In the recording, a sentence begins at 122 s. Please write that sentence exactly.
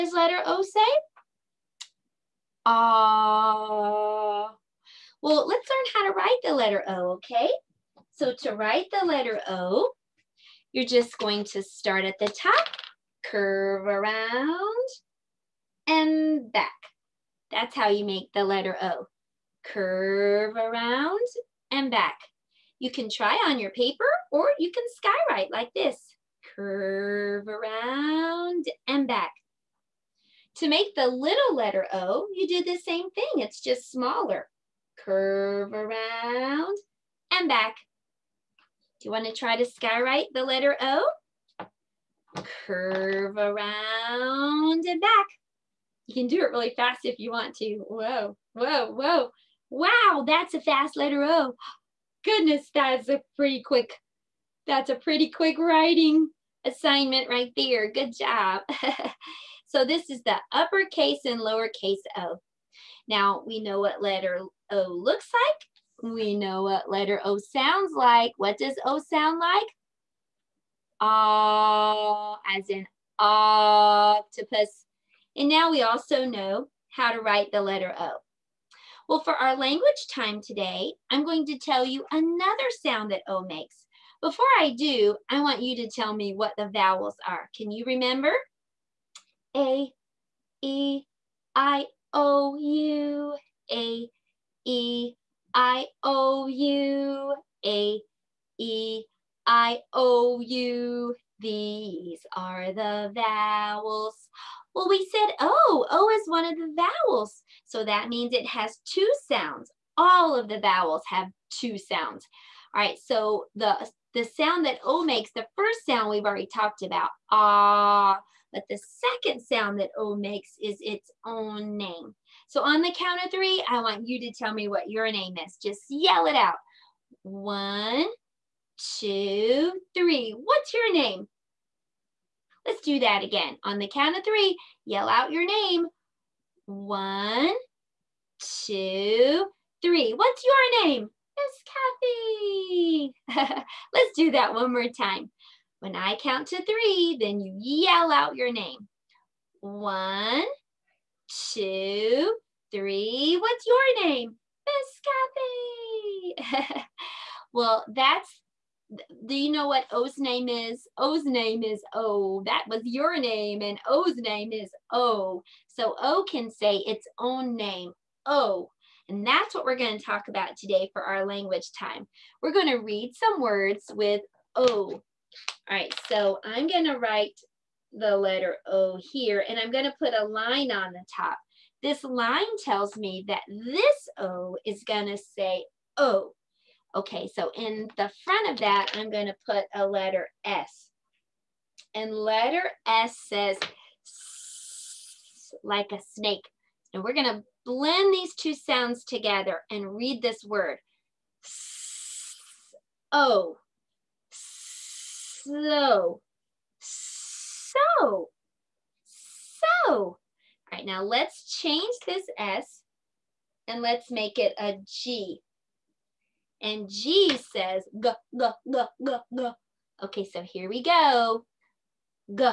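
So on the count of three, I want you to tell me what your name is.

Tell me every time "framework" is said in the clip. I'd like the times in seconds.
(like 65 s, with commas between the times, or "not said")
not said.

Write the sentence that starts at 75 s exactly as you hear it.
And now we also know how to write the letter O.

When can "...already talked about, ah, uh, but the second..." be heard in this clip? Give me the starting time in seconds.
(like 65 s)
116 s.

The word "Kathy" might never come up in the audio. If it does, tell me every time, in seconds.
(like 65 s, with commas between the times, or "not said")
143 s, 156 s.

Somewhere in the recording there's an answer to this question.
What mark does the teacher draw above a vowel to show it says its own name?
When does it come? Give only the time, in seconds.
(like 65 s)
180 s.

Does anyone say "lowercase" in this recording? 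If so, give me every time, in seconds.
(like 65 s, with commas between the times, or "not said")
61 s.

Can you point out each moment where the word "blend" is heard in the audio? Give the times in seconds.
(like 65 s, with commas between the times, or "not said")
197 s.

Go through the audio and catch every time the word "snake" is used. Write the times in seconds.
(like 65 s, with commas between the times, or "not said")
196 s.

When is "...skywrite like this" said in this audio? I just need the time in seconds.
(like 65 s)
25 s.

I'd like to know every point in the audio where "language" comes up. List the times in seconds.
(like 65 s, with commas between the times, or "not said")
79 s, 171 s.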